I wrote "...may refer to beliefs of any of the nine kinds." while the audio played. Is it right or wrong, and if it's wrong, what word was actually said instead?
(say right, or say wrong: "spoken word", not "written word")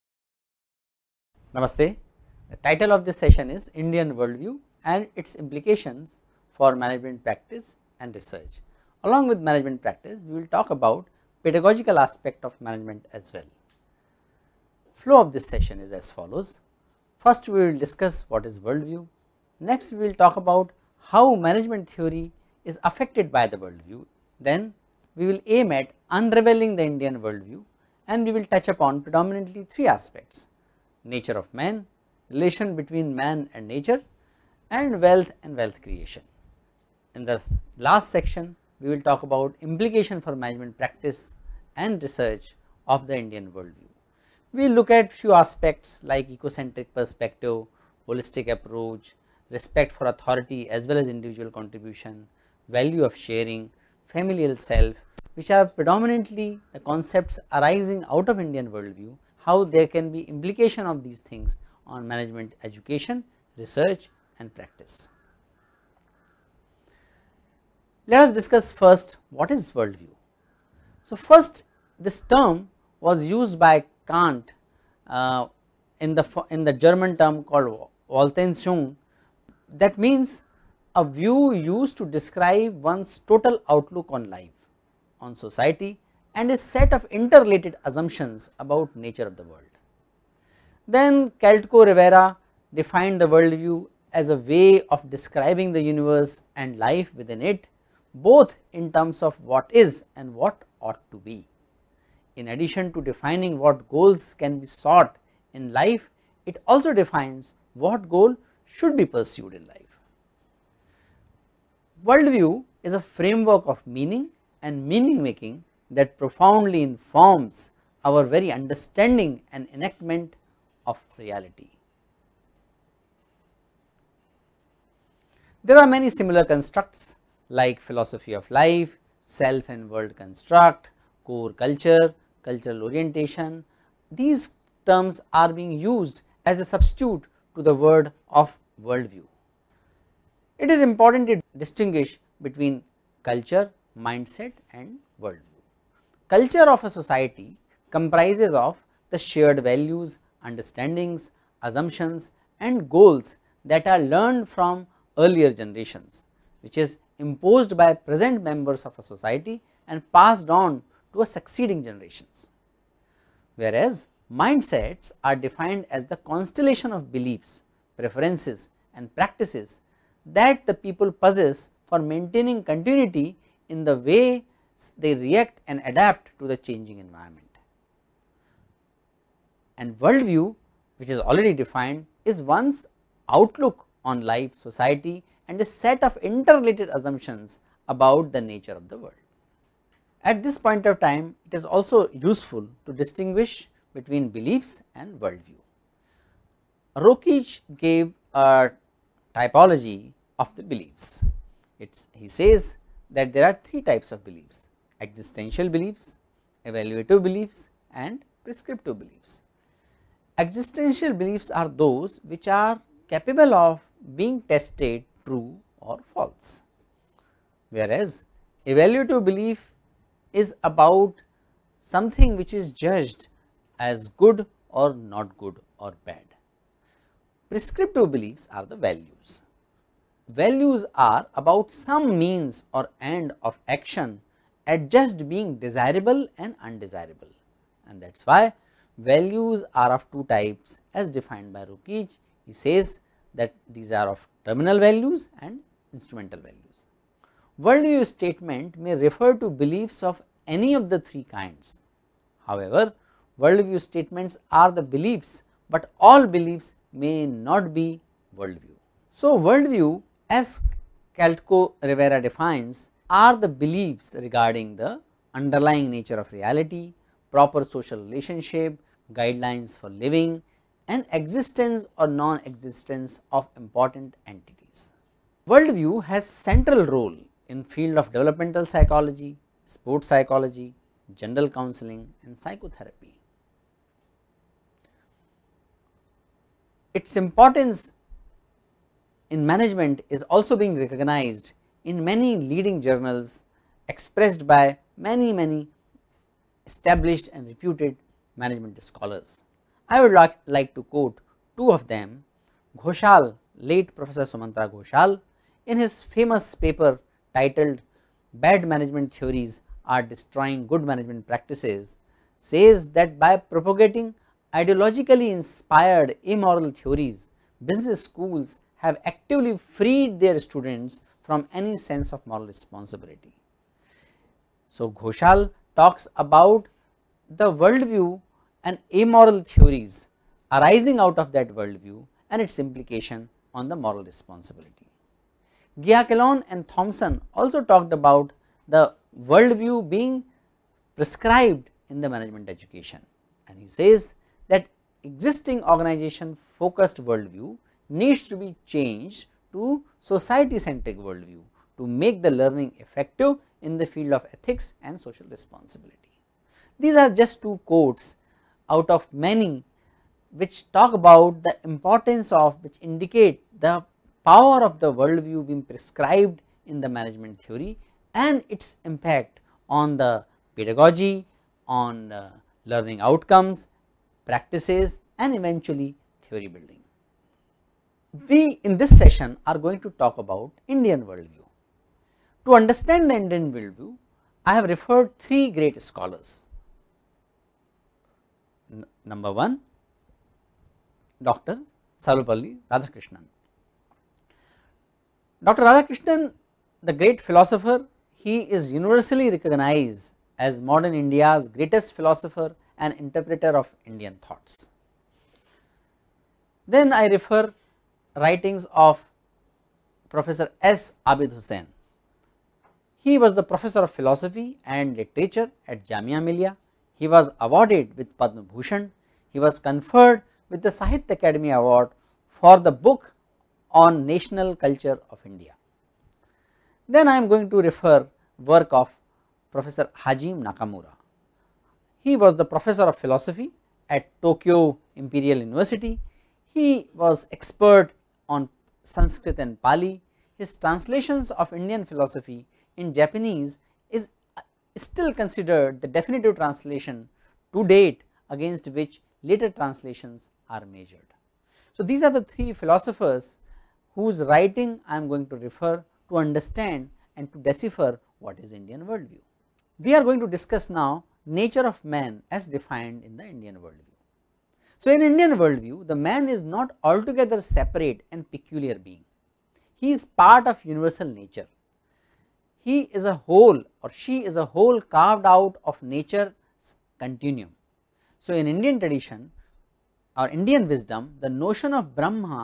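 wrong: "three", not "nine".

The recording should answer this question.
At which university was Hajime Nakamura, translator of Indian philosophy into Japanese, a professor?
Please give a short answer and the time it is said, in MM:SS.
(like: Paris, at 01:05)
Tokyo Imperial University, at 07:14.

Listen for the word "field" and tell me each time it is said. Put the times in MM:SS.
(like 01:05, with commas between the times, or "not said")
04:37, 05:53.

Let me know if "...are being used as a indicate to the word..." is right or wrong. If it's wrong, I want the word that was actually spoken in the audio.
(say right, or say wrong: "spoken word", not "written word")
wrong: "substitute", not "indicate".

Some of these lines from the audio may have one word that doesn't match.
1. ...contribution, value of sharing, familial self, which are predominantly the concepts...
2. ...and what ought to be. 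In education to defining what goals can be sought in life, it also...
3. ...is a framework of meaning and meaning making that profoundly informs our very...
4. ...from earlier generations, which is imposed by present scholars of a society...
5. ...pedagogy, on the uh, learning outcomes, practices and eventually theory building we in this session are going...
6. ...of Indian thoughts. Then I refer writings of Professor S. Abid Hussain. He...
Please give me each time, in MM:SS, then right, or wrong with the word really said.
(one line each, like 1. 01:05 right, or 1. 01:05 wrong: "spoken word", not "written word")
1. 00:51 right
2. 01:40 wrong: "addition", not "education"
3. 01:52 right
4. 02:34 wrong: "members", not "scholars"
5. 06:10 right
6. 06:43 right.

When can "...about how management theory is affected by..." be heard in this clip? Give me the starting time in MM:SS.
00:20.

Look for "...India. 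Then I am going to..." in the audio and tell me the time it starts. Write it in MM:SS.
07:05.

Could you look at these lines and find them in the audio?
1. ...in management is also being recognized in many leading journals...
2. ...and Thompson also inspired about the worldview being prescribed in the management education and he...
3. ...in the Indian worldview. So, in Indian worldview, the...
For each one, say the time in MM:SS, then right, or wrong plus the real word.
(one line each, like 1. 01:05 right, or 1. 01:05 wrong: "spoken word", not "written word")
1. 04:49 right
2. 05:36 wrong: "talked", not "inspired"
3. 07:43 right.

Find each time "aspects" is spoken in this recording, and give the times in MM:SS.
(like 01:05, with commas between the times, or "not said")
00:11, 00:29, 00:45.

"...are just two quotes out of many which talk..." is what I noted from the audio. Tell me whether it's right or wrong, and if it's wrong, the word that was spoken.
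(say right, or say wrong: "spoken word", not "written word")
right.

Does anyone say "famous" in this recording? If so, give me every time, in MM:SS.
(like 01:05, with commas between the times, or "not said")
05:06.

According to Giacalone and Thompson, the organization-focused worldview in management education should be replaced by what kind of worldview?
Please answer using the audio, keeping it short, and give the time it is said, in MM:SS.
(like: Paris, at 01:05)
Society-centric, at 05:49.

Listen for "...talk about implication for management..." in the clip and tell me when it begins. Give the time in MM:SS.
00:39.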